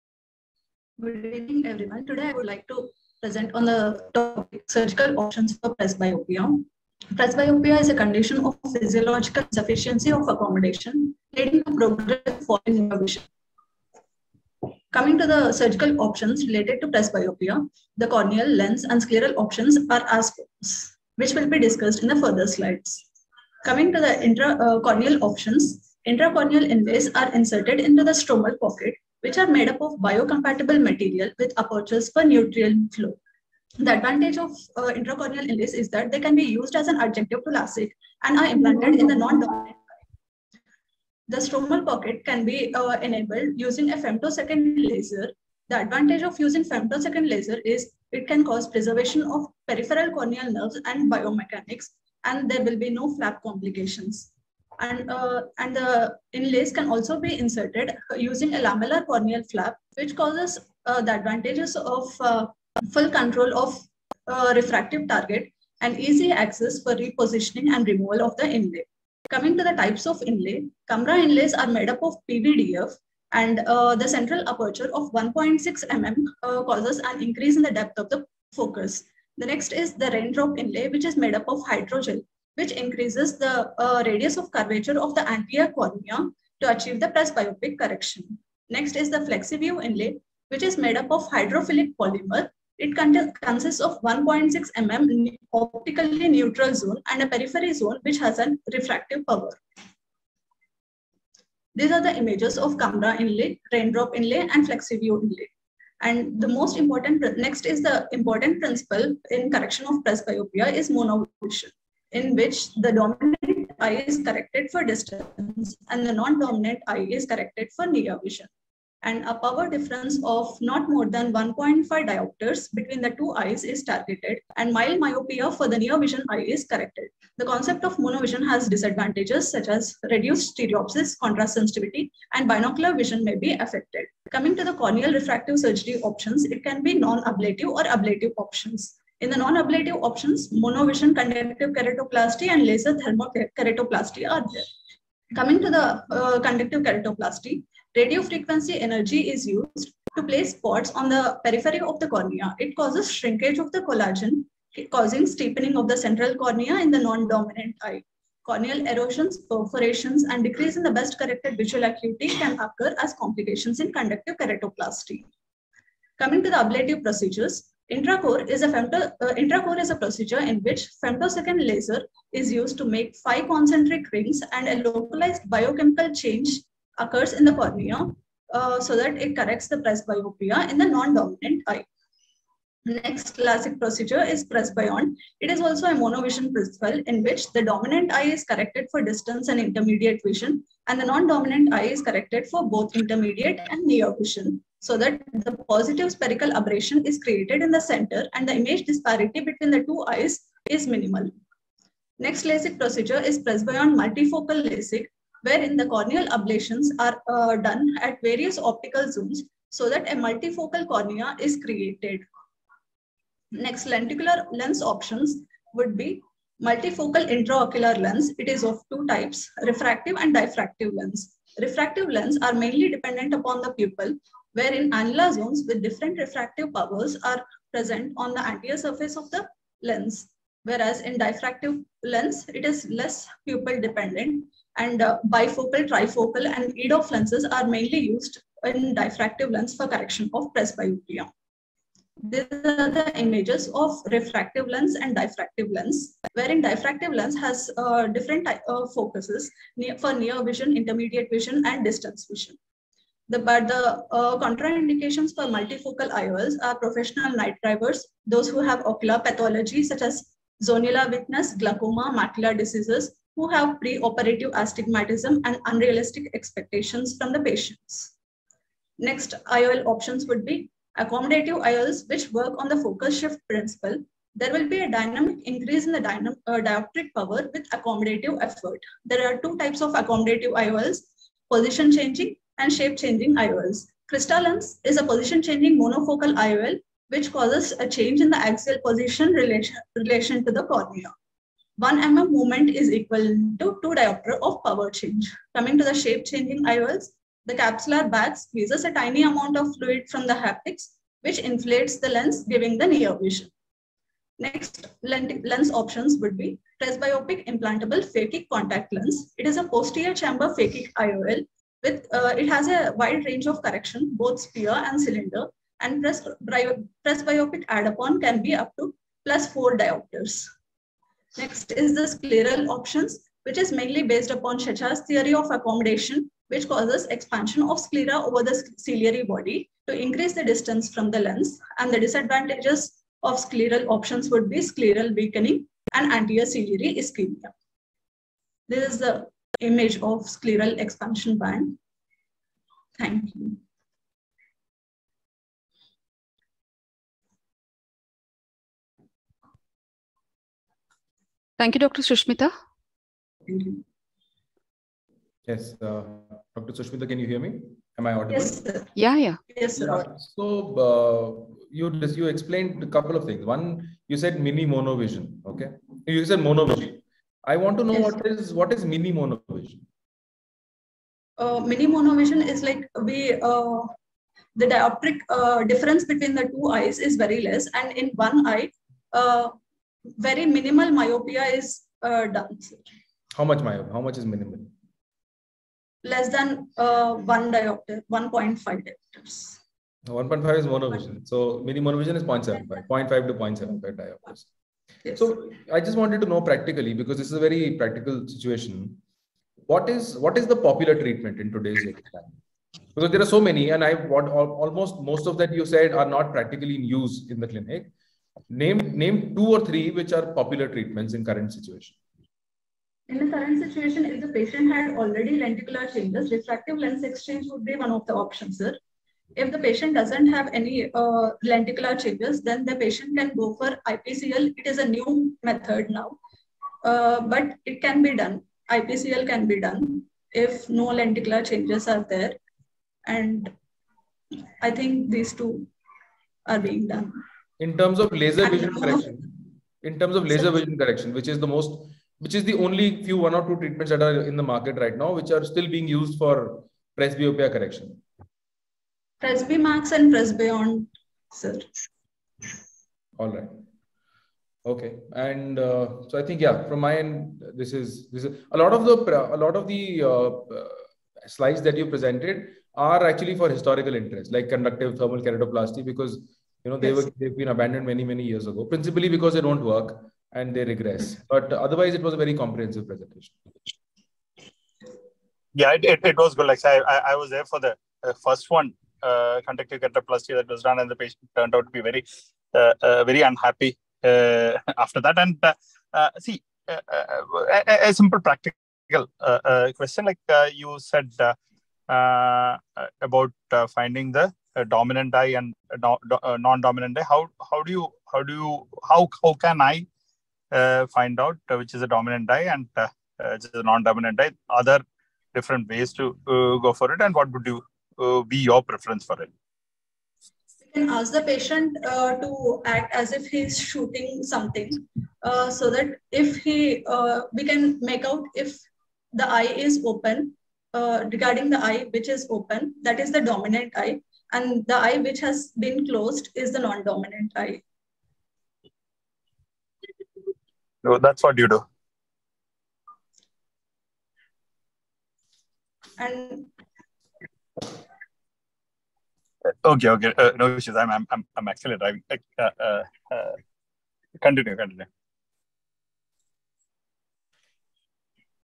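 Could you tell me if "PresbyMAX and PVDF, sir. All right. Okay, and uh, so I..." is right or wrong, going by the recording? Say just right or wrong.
wrong.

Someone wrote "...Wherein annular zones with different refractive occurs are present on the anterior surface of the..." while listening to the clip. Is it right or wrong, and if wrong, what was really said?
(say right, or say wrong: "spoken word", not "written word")
wrong: "powers", not "occurs".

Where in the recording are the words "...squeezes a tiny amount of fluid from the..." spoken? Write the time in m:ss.
4:58.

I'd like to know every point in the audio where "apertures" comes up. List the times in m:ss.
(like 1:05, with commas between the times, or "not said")
0:31, 1:14.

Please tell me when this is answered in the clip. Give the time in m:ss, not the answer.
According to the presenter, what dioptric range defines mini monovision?
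6:32.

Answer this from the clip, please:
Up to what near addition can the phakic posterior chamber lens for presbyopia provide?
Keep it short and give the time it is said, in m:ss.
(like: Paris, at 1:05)
+4 diopters, at 5:19.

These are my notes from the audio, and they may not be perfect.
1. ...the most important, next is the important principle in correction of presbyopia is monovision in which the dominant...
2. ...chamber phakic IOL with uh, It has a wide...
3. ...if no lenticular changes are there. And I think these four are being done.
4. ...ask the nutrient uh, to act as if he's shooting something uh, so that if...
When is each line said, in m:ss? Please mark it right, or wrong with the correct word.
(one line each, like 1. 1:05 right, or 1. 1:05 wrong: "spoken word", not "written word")
1. 1:46 right
2. 5:10 right
3. 7:10 wrong: "two", not "four"
4. 8:30 wrong: "patient", not "nutrient".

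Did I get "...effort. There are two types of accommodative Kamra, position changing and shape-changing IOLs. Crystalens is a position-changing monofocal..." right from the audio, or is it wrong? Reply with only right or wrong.
wrong.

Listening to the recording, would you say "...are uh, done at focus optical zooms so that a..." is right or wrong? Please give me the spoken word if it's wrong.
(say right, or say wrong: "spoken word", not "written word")
wrong: "various", not "focus".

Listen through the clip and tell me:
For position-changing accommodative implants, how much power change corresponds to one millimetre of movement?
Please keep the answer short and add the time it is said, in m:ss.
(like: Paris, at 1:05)
2 diopters, at 4:53.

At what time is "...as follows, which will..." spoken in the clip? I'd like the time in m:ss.
0:20.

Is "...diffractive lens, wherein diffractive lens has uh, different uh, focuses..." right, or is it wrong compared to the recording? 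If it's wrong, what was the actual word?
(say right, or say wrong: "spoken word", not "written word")
right.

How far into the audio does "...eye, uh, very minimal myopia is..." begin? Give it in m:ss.
6:18.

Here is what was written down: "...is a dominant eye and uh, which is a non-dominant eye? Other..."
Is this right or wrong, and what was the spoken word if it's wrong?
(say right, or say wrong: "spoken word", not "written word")
right.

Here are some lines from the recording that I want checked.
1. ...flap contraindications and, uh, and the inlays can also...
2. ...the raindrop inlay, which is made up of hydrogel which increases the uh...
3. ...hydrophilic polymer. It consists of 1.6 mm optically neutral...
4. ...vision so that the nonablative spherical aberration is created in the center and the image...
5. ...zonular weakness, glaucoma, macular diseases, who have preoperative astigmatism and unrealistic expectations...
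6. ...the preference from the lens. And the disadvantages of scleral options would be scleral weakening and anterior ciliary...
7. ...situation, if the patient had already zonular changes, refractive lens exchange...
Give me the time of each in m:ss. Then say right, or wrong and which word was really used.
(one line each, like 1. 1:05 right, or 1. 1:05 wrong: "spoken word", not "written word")
1. 0:53 wrong: "complications", not "contraindications"
2. 1:19 right
3. 1:31 right
4. 3:14 wrong: "positive", not "nonablative"
5. 4:20 right
6. 5:30 wrong: "distance", not "preference"
7. 6:53 wrong: "lenticular", not "zonular".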